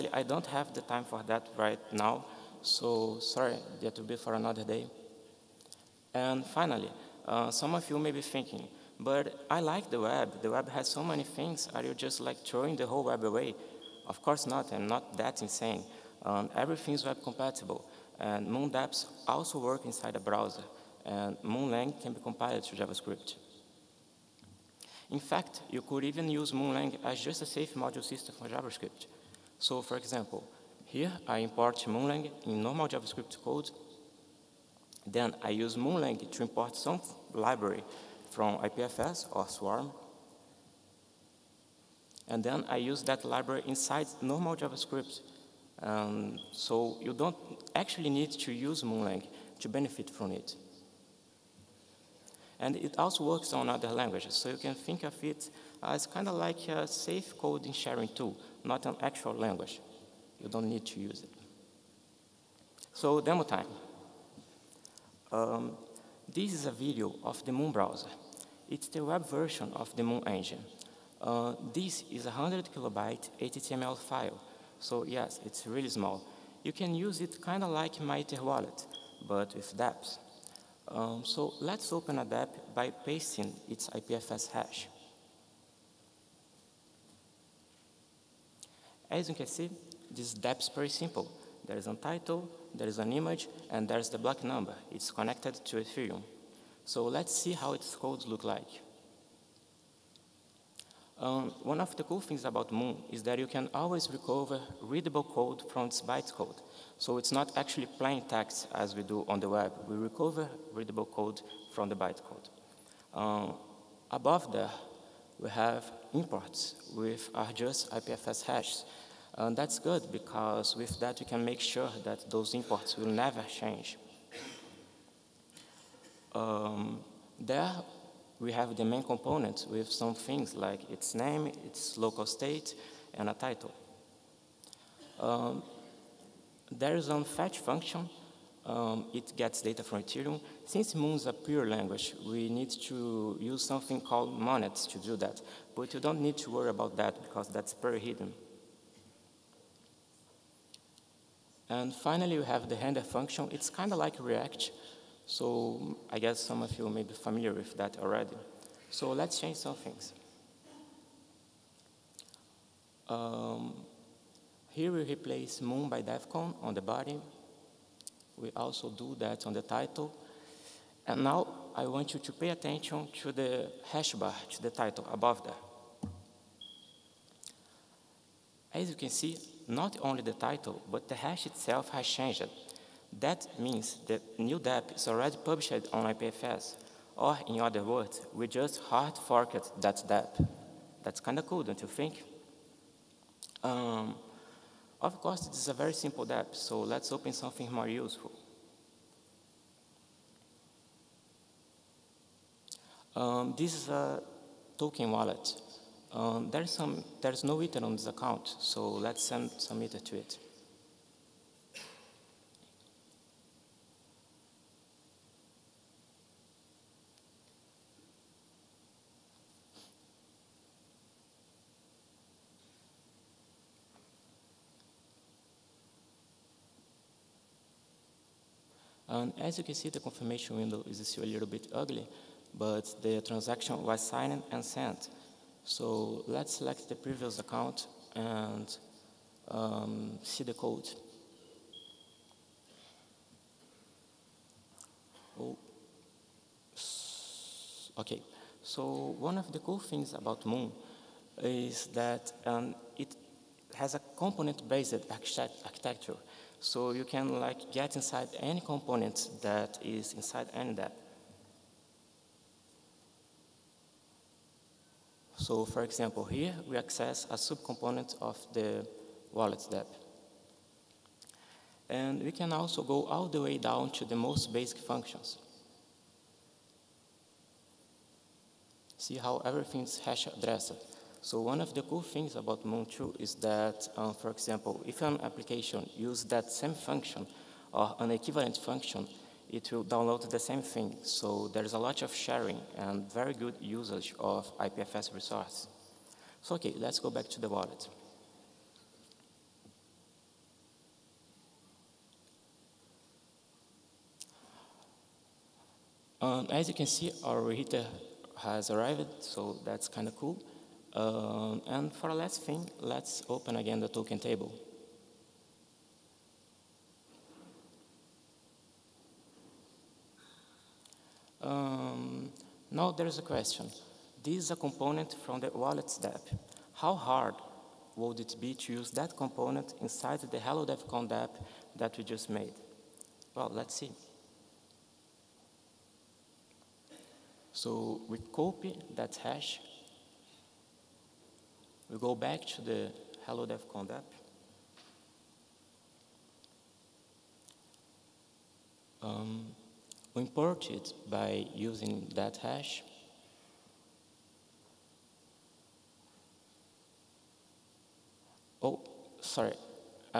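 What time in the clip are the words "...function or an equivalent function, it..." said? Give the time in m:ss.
4:46.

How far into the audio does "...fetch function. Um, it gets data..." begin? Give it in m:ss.
2:17.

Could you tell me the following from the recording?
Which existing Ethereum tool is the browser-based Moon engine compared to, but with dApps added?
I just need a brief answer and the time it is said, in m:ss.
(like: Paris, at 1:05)
MyEtherWallet, at 1:17.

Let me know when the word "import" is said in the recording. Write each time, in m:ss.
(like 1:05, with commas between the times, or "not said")
0:31, 0:36, 1:56, 2:02, 5:50.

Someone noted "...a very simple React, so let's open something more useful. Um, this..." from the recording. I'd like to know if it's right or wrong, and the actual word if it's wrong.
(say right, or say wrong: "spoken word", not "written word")
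wrong: "DAP", not "React".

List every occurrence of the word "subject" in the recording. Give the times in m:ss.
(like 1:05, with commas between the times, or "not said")
not said.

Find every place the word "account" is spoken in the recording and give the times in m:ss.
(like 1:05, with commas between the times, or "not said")
3:28, 3:57.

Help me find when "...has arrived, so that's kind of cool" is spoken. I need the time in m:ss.
5:08.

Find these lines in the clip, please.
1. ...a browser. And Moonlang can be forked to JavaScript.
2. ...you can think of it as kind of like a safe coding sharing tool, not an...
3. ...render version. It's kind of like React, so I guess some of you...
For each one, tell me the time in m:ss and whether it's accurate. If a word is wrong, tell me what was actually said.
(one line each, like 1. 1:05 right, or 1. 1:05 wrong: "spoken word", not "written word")
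1. 0:20 wrong: "compiled", not "forked"
2. 0:54 right
3. 2:32 wrong: "function", not "version".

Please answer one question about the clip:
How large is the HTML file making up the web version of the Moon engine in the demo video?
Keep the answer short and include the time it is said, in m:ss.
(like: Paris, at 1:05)
100 kilobytes, at 1:12.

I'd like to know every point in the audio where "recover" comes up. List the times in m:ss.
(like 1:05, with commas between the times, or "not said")
1:44, 1:49.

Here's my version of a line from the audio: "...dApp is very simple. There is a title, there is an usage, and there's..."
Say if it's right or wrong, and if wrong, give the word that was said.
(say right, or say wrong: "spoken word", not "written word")
wrong: "image", not "usage".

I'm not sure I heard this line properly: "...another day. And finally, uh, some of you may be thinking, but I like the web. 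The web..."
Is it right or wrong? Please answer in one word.
right.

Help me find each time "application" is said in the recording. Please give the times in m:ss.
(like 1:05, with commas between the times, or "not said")
4:45.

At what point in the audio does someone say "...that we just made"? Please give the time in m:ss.
5:31.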